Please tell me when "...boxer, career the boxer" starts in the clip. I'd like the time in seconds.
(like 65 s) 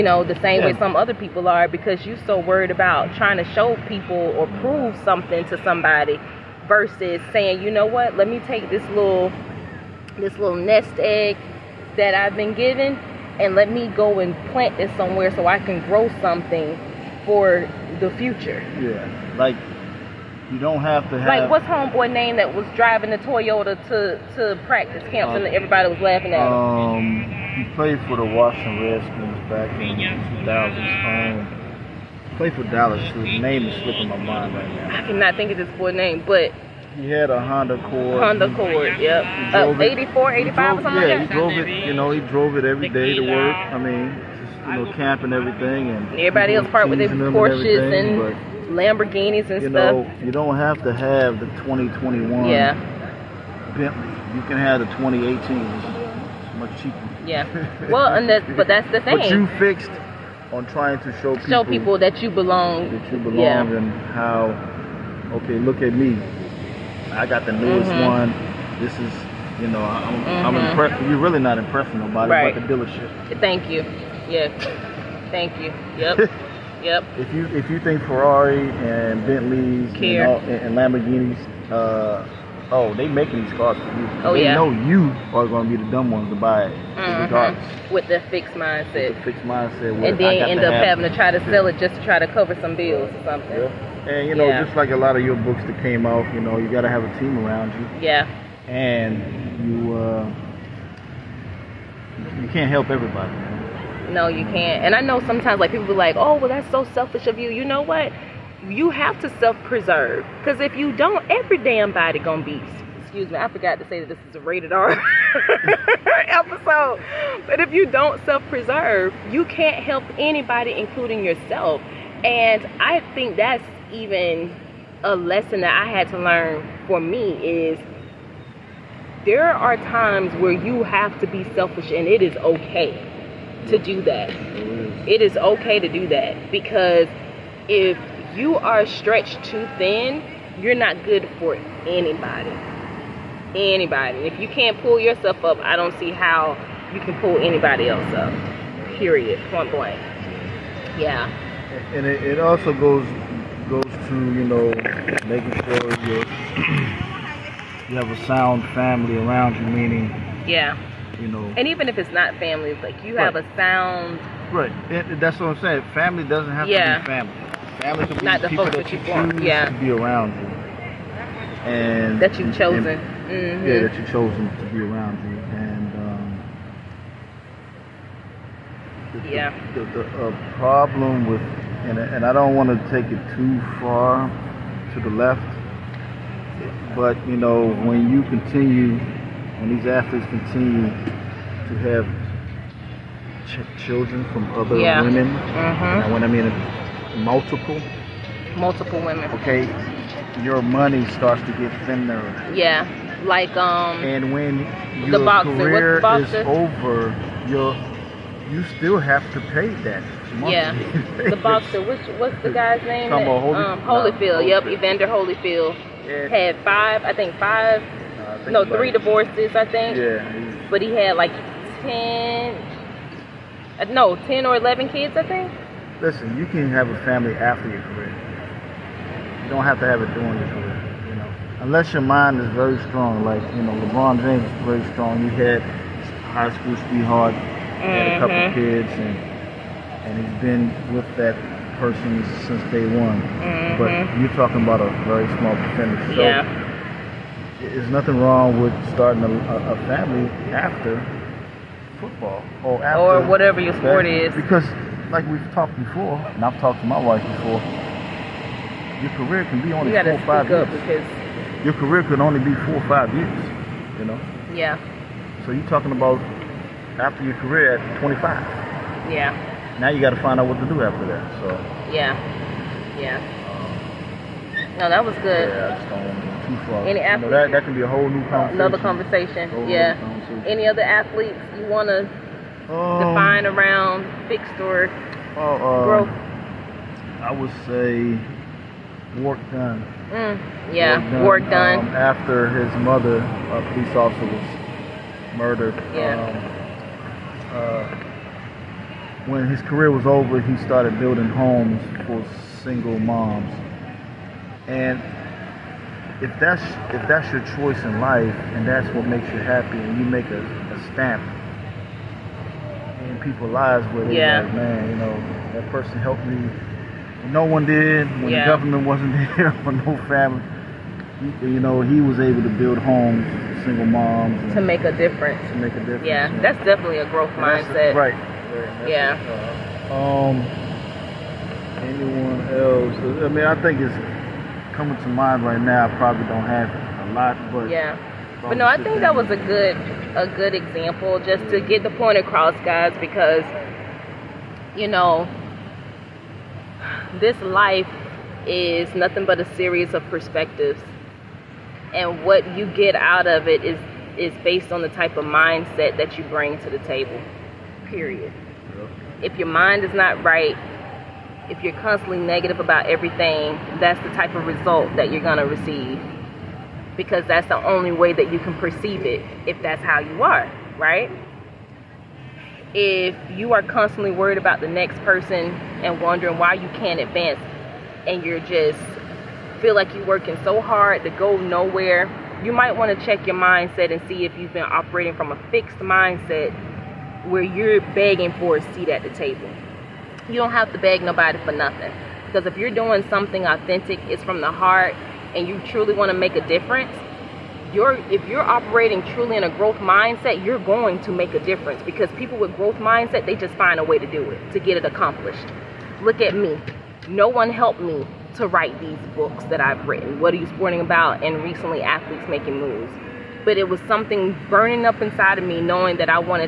205 s.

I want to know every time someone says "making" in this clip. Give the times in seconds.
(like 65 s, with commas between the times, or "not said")
83 s, 155 s, 412 s.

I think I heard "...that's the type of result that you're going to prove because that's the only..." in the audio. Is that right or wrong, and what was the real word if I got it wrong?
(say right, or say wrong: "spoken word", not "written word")
wrong: "receive", not "prove".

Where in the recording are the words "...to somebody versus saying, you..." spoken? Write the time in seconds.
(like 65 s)
5 s.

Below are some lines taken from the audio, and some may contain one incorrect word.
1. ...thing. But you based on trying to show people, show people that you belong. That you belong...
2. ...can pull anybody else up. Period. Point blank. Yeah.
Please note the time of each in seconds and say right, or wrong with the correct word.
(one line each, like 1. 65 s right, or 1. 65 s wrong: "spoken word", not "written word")
1. 59 s wrong: "fixed", not "based"
2. 147 s right.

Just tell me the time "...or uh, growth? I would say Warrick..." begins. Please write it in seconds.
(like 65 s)
284 s.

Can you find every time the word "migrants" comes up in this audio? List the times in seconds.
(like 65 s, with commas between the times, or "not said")
not said.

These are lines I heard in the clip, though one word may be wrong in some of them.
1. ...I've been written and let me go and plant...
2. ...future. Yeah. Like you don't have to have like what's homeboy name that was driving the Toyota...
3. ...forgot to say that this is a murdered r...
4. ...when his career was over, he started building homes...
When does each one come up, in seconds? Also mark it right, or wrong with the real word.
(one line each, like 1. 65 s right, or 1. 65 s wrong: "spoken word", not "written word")
1. 12 s wrong: "given", not "written"
2. 18 s right
3. 113 s wrong: "rated", not "murdered"
4. 299 s right.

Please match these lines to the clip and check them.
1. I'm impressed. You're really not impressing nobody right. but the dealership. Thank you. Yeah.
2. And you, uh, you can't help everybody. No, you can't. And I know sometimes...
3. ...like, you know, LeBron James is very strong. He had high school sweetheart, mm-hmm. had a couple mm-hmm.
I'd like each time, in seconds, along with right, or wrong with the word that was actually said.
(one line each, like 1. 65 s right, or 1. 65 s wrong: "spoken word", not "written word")
1. 70 s right
2. 98 s right
3. 233 s right.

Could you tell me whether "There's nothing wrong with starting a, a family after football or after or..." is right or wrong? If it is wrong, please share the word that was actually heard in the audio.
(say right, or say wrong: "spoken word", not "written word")
right.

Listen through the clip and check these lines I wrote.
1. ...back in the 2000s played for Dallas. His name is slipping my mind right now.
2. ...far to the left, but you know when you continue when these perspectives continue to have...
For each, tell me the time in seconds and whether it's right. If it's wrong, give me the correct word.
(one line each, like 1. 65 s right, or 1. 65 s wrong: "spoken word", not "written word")
1. 29 s right
2. 183 s wrong: "athletes", not "perspectives".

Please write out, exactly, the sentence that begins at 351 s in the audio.
And what you get out of it is is based on the type of mindset that you bring to the table.